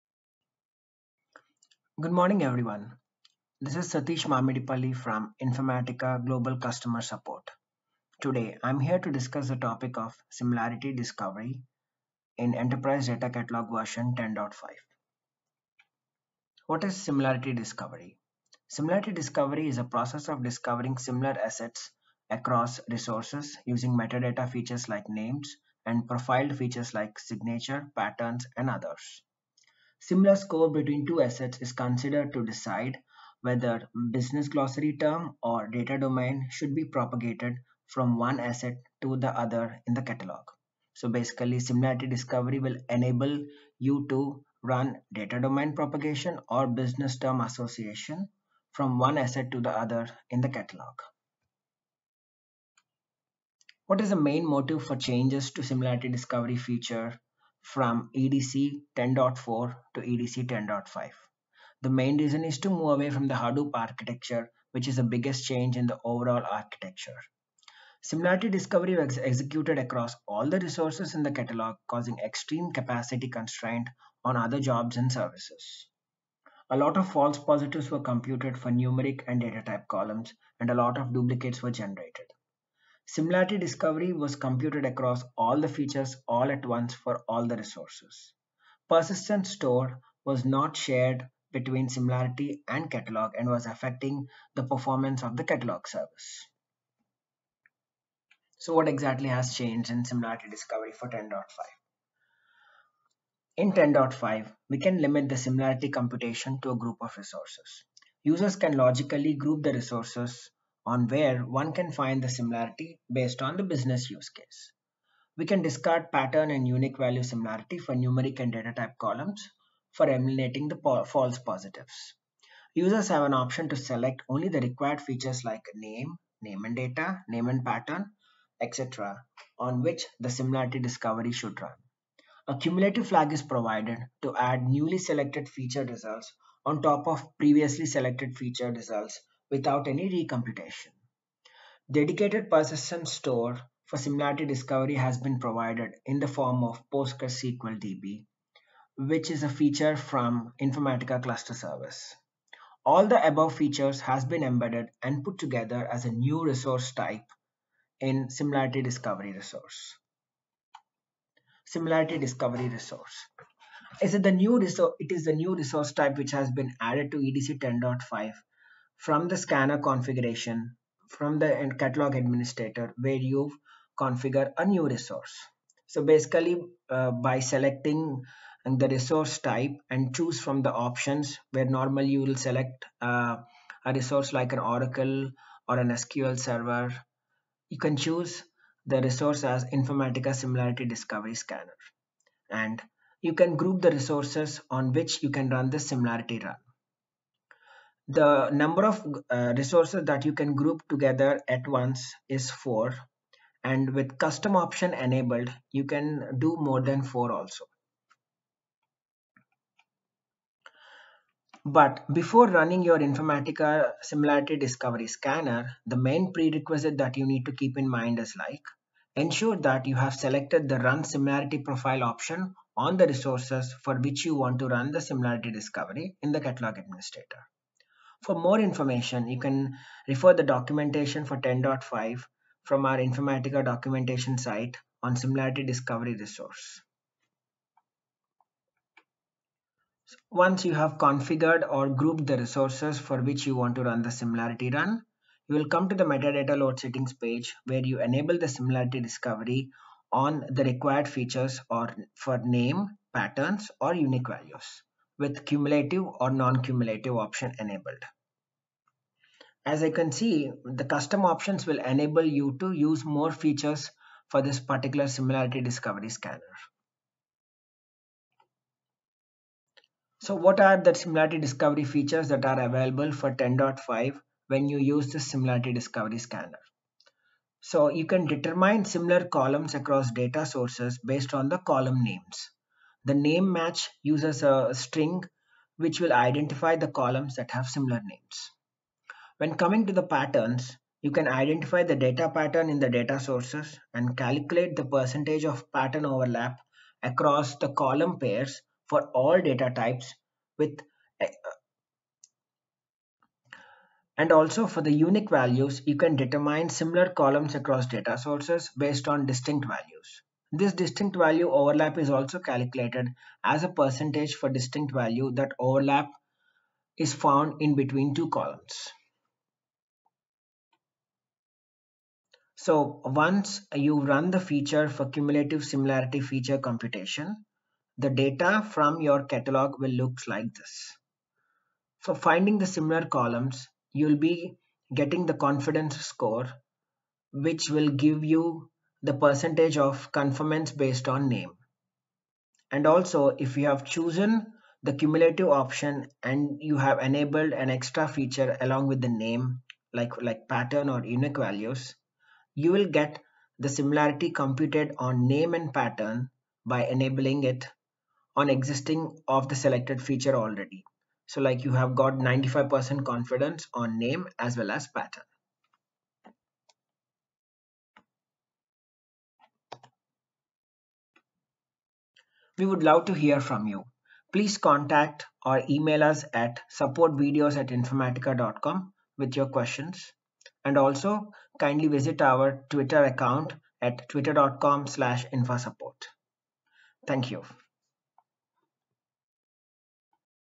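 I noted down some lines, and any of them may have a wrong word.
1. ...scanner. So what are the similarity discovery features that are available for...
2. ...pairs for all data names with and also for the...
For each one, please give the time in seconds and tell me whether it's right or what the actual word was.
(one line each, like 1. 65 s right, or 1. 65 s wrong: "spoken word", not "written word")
1. 266 s right
2. 298 s wrong: "types", not "names".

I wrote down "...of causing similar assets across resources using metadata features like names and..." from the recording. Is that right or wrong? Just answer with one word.
wrong.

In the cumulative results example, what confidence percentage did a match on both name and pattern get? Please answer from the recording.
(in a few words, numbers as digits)
95%.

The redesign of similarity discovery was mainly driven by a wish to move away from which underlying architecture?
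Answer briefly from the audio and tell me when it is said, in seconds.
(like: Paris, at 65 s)
Hadoop, at 63 s.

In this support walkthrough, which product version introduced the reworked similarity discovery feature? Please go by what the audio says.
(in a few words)
10.5.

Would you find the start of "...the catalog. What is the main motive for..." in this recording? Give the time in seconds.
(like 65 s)
50 s.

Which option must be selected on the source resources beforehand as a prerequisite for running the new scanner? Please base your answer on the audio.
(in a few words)
Run Similarity Profile.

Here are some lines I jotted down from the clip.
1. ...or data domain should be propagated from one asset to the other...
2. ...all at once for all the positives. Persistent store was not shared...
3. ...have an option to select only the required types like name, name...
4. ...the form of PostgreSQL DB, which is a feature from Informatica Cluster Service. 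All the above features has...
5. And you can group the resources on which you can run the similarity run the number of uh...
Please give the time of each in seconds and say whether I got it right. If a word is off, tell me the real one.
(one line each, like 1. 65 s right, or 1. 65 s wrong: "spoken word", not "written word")
1. 35 s right
2. 86 s wrong: "resources", not "positives"
3. 123 s wrong: "features", not "types"
4. 146 s right
5. 192 s right.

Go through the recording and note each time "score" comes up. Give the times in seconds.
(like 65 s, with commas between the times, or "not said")
30 s, 336 s.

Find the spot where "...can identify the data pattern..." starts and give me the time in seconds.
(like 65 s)
291 s.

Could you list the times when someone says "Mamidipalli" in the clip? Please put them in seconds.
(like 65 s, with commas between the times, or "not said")
4 s.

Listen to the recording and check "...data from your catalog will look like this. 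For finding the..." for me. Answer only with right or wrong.
right.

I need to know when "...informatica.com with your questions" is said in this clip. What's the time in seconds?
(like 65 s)
377 s.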